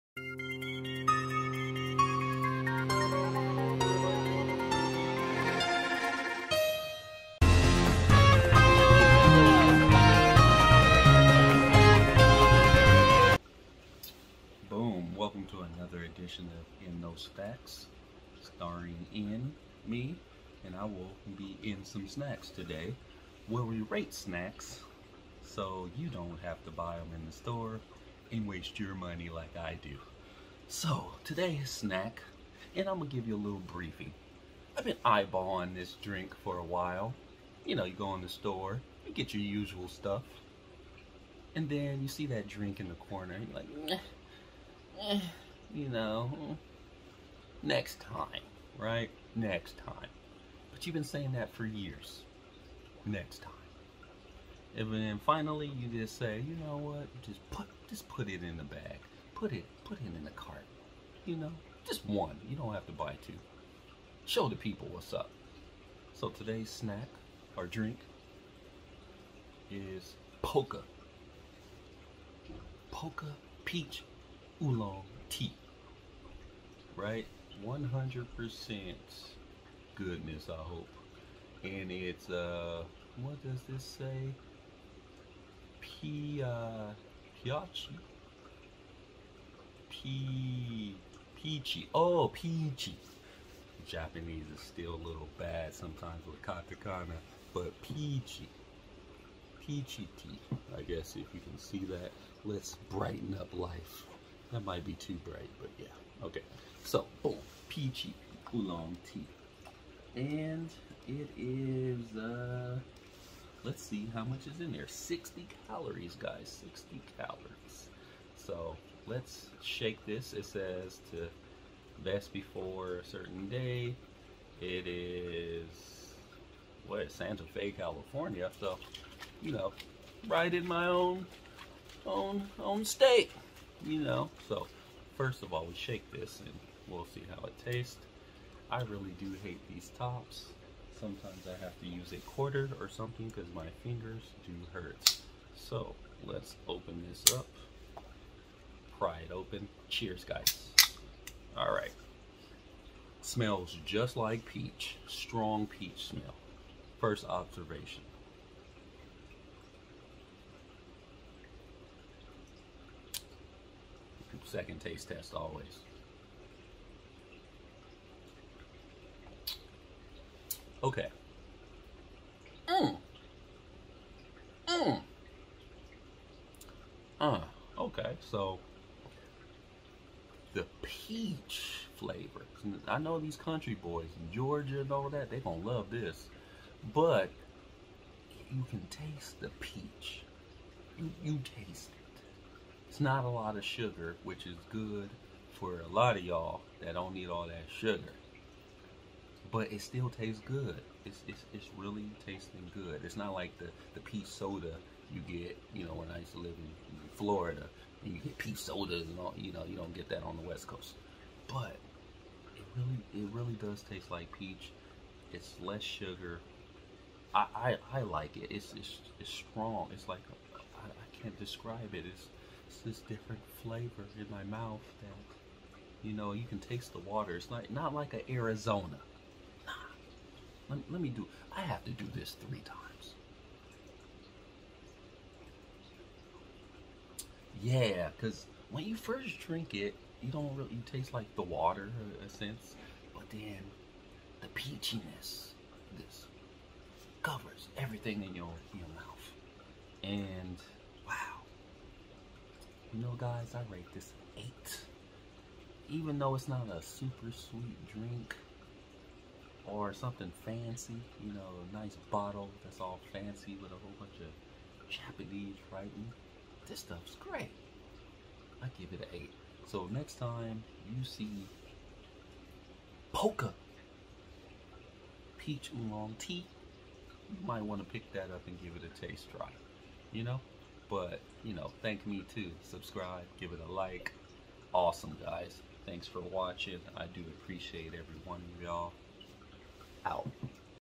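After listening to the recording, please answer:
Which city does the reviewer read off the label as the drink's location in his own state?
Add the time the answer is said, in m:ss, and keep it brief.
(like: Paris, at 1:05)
Santa Fe, at 2:07.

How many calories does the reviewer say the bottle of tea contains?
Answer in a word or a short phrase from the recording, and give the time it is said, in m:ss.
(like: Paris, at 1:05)
60, at 1:54.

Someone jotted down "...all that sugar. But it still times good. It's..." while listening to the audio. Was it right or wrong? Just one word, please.
wrong.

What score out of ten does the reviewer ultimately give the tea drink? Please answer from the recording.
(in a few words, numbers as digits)
8.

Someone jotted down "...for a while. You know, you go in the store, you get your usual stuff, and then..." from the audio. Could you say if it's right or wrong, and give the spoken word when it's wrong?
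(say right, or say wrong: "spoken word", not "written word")
right.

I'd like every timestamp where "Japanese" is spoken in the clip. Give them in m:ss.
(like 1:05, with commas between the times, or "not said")
1:33, 4:24.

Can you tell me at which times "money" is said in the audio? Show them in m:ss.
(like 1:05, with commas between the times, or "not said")
0:28.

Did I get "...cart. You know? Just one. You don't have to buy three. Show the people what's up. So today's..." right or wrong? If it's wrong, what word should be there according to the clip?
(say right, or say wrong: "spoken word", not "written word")
wrong: "two", not "three".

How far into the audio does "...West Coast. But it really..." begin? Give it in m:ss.
3:30.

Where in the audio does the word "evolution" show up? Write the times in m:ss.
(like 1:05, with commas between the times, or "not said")
not said.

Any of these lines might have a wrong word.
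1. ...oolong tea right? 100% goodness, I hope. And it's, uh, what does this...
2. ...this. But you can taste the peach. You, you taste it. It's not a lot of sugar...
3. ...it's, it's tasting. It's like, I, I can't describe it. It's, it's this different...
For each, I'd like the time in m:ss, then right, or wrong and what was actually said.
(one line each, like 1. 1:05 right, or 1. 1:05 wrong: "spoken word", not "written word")
1. 1:14 right
2. 3:05 right
3. 3:38 wrong: "strong", not "tasting".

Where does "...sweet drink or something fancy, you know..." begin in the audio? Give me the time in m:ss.
4:17.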